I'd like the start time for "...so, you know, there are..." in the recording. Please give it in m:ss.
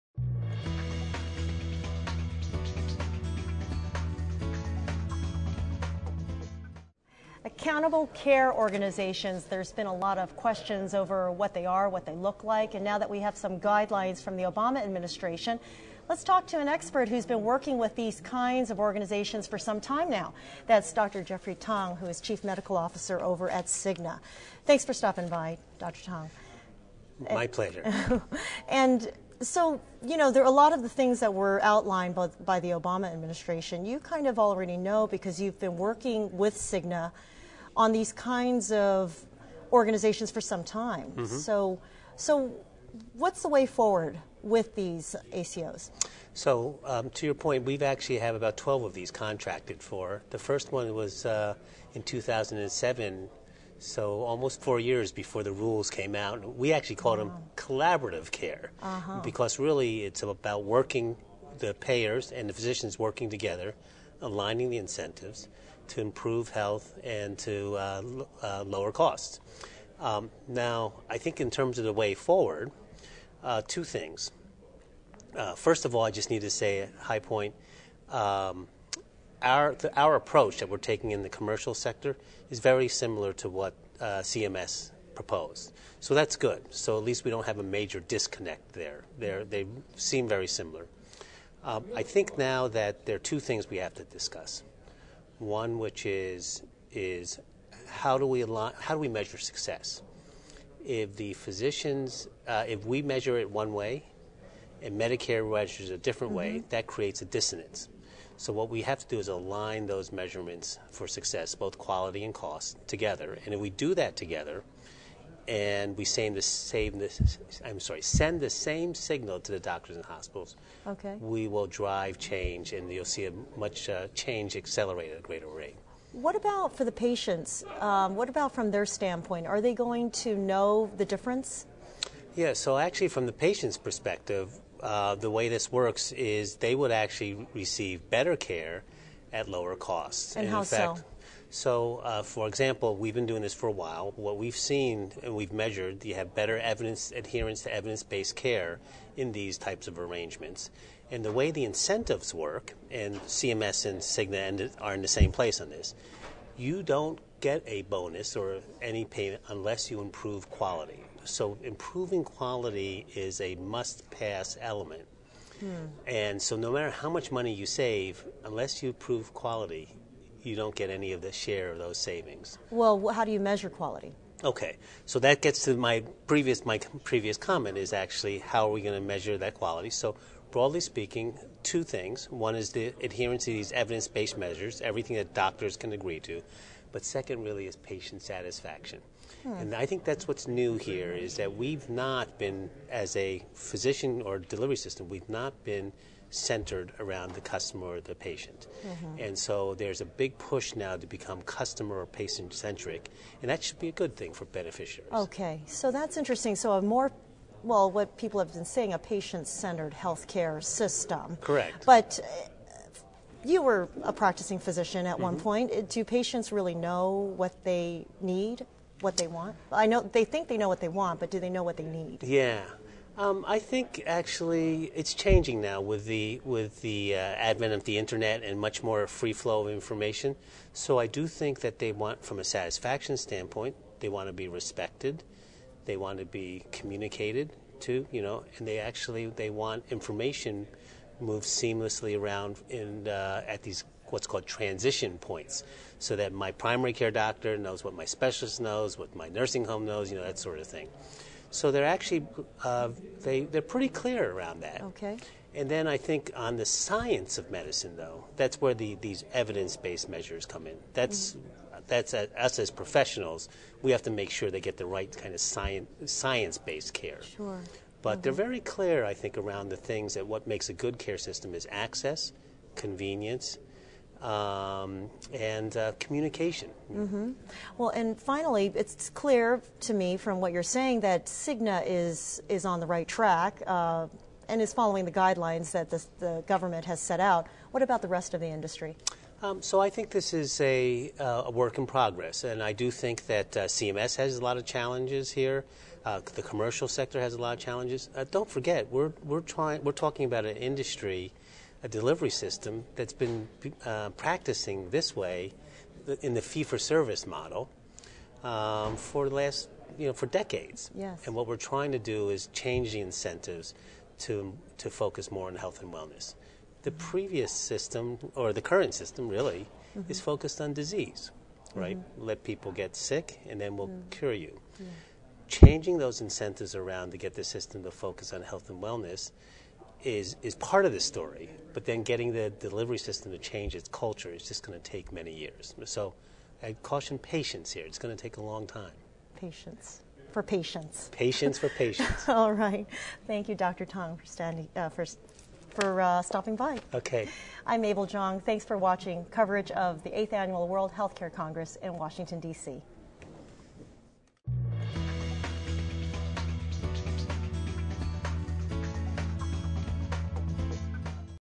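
0:29.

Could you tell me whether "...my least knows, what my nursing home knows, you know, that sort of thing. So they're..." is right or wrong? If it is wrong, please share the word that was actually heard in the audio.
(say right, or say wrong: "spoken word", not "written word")
wrong: "specialist", not "least".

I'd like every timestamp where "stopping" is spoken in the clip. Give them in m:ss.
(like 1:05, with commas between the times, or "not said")
0:24, 5:46.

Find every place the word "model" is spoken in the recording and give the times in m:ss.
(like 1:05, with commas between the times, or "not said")
5:07.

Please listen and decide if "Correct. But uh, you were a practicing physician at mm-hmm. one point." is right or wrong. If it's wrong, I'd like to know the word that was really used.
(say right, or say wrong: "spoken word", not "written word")
right.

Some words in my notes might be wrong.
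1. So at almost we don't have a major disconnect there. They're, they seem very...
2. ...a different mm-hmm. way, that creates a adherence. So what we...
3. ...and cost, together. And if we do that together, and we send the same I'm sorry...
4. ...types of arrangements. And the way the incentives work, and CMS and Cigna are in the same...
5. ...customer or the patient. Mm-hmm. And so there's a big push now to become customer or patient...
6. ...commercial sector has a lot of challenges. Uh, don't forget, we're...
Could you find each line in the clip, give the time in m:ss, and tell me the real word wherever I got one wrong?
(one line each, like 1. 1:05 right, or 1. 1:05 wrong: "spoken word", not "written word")
1. 1:26 wrong: "least", not "almost"
2. 1:45 wrong: "dissonance", not "adherence"
3. 1:52 right
4. 2:29 right
5. 3:17 right
6. 4:56 right.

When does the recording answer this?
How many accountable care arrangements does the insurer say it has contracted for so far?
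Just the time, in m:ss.
0:48.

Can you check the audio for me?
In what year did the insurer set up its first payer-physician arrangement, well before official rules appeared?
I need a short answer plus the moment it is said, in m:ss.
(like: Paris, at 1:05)
2007, at 0:52.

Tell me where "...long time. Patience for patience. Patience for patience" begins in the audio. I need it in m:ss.
5:38.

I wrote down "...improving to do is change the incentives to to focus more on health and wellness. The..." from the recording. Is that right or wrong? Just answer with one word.
wrong.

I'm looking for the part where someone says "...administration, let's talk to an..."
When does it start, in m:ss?
0:14.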